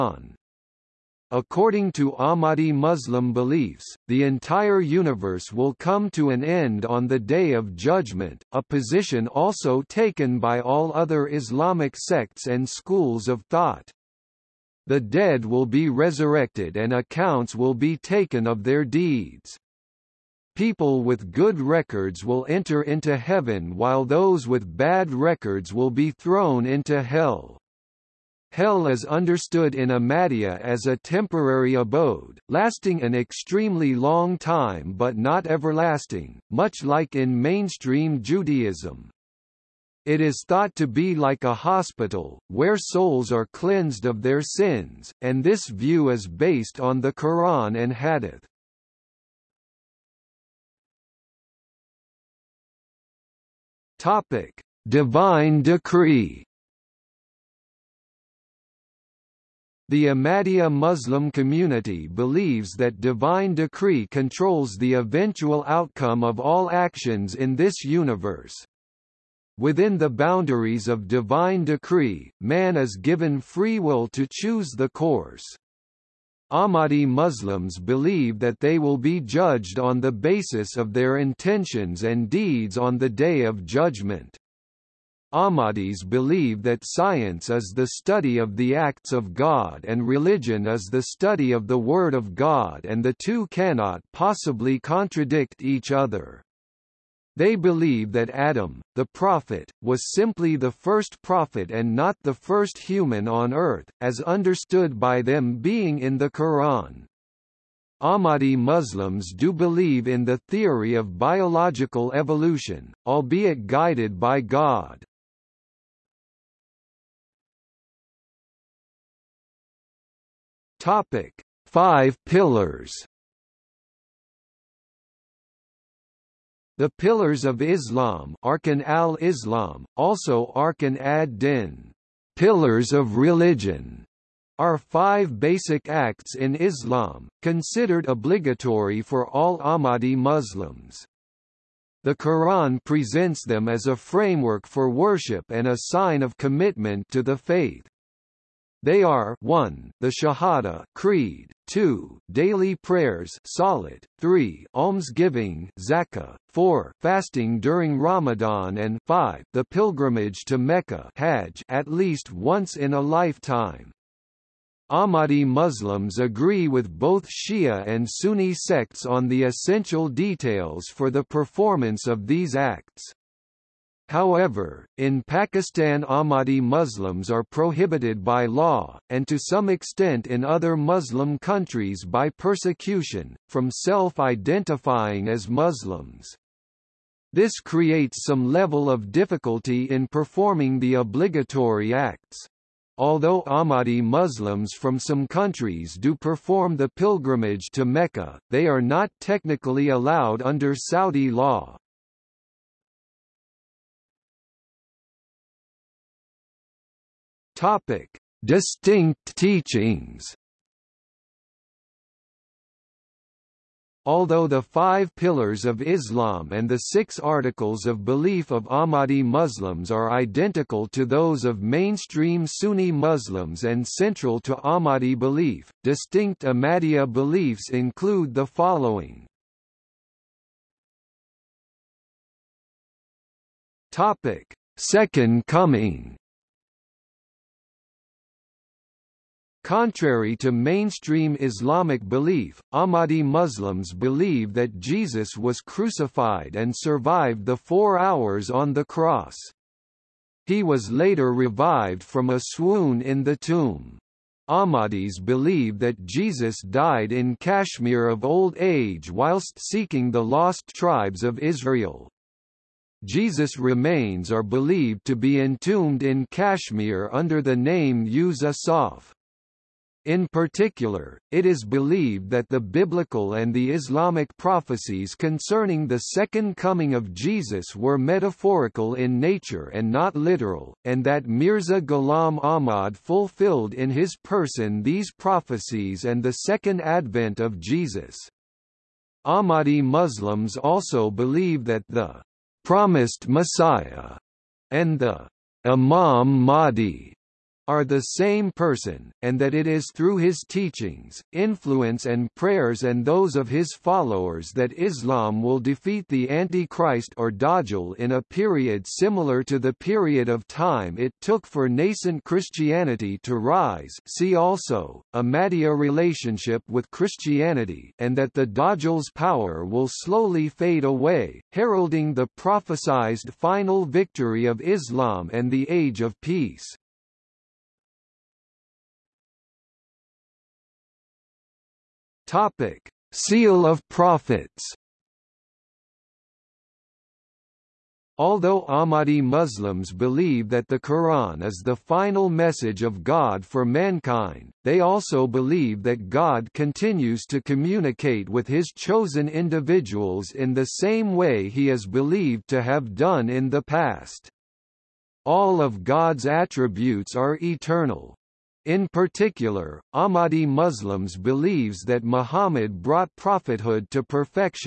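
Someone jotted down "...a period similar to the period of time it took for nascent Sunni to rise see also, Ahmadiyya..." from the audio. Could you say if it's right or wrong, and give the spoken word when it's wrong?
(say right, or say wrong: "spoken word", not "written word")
wrong: "Christianity", not "Sunni".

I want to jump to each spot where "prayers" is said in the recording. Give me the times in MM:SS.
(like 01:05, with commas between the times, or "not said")
02:32, 05:02.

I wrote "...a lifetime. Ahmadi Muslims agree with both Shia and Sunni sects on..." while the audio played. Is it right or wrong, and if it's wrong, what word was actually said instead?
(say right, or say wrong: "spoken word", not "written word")
right.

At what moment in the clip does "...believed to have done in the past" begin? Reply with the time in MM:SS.
05:51.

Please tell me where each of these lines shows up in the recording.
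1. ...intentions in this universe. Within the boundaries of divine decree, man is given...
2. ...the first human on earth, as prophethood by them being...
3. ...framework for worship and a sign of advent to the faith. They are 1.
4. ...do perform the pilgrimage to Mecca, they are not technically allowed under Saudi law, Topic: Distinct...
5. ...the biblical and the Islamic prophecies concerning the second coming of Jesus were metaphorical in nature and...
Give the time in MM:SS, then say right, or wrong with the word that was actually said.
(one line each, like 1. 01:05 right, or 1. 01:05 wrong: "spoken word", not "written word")
1. 01:06 wrong: "actions", not "intentions"
2. 01:42 wrong: "understood", not "prophethood"
3. 02:23 wrong: "commitment", not "advent"
4. 03:15 right
5. 04:32 right.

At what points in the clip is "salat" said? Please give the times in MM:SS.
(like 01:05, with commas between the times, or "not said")
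02:33.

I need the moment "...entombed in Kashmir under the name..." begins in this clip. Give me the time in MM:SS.
04:25.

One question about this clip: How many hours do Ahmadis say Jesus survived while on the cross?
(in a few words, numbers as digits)
4.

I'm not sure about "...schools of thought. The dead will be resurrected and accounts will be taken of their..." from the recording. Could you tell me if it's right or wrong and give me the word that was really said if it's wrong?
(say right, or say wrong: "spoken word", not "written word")
right.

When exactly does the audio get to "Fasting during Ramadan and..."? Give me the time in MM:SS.
02:36.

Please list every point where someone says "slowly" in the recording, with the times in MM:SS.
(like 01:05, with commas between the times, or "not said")
05:19.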